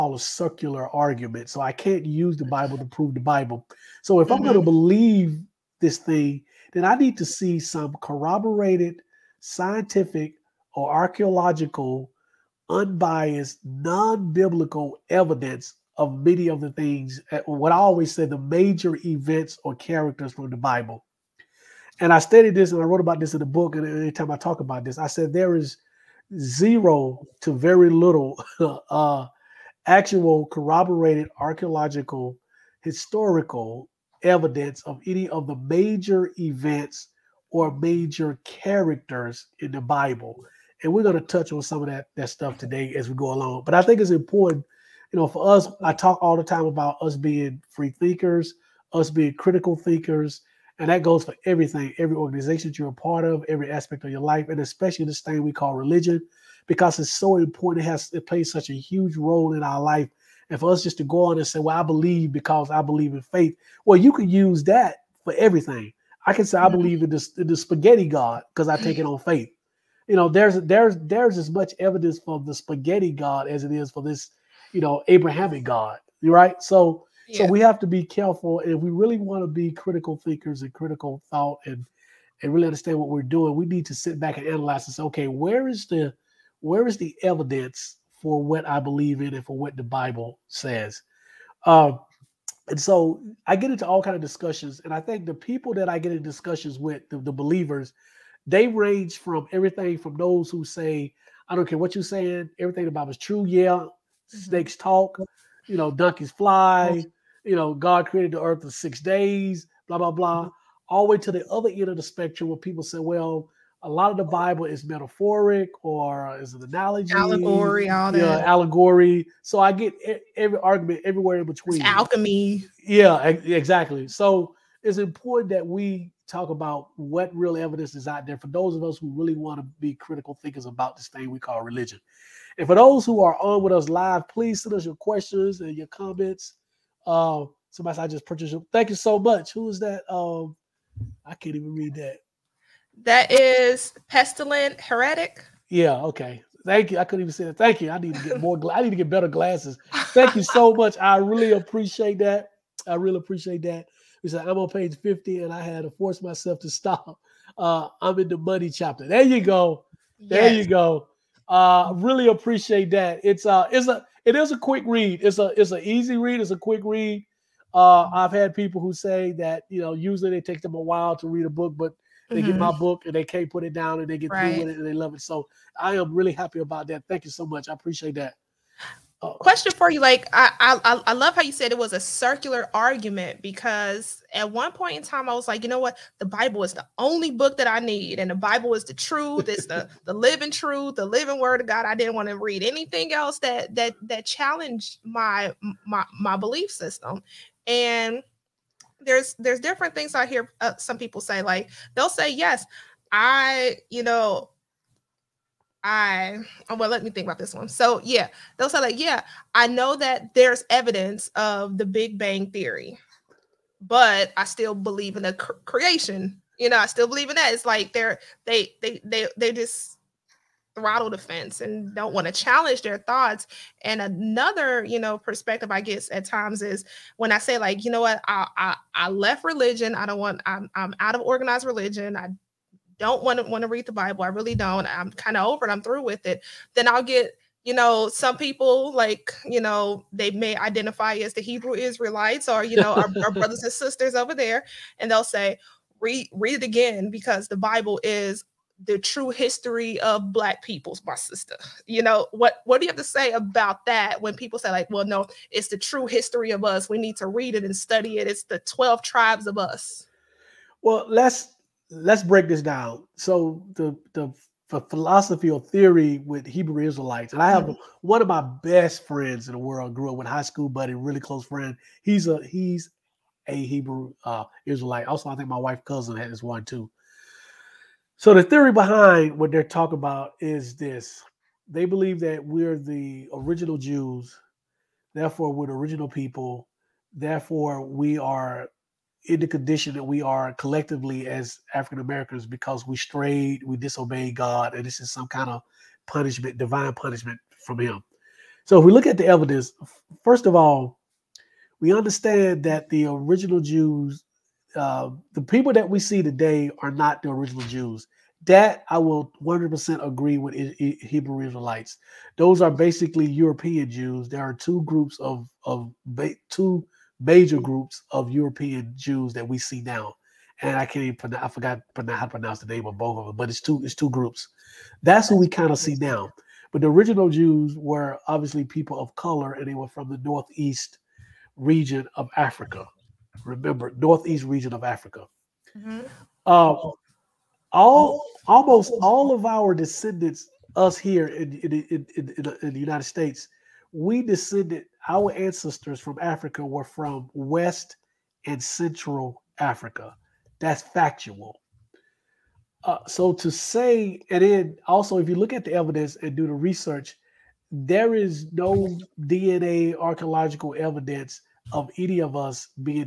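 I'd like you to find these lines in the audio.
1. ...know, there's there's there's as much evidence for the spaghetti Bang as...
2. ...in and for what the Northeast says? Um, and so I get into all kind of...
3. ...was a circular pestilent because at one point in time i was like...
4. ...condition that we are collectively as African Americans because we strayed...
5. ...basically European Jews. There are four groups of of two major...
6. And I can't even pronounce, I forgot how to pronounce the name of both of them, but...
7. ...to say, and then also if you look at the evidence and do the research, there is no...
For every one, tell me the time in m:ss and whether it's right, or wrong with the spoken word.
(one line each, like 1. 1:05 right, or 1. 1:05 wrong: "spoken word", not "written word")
1. 1:10 wrong: "God", not "Bang"
2. 1:29 wrong: "Bible", not "Northeast"
3. 3:01 wrong: "argument", not "pestilent"
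4. 4:49 right
5. 5:12 wrong: "two", not "four"
6. 5:20 right
7. 5:53 right.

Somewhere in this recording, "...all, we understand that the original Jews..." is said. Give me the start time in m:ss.
5:00.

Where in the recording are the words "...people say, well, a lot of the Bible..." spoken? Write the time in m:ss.
1:52.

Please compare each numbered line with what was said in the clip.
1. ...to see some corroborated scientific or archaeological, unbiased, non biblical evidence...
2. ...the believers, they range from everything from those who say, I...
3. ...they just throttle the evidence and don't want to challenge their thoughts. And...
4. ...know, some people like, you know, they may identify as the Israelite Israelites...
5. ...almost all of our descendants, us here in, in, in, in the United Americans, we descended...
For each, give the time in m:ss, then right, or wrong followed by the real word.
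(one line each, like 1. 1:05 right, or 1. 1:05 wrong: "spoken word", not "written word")
1. 0:07 right
2. 1:37 right
3. 3:39 wrong: "fence", not "evidence"
4. 3:57 wrong: "Hebrew", not "Israelite"
5. 5:38 wrong: "States", not "Americans".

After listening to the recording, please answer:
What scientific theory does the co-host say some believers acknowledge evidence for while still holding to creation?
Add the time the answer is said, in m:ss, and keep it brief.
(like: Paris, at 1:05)
the Big Bang theory, at 3:31.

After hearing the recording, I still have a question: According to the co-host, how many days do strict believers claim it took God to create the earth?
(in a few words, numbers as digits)
6.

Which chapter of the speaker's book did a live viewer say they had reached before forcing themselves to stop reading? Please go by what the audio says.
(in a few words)
the money chapter.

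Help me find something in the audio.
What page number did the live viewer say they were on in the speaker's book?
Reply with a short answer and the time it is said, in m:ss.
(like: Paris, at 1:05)
50, at 2:34.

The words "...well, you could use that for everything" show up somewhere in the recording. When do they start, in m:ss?
1:03.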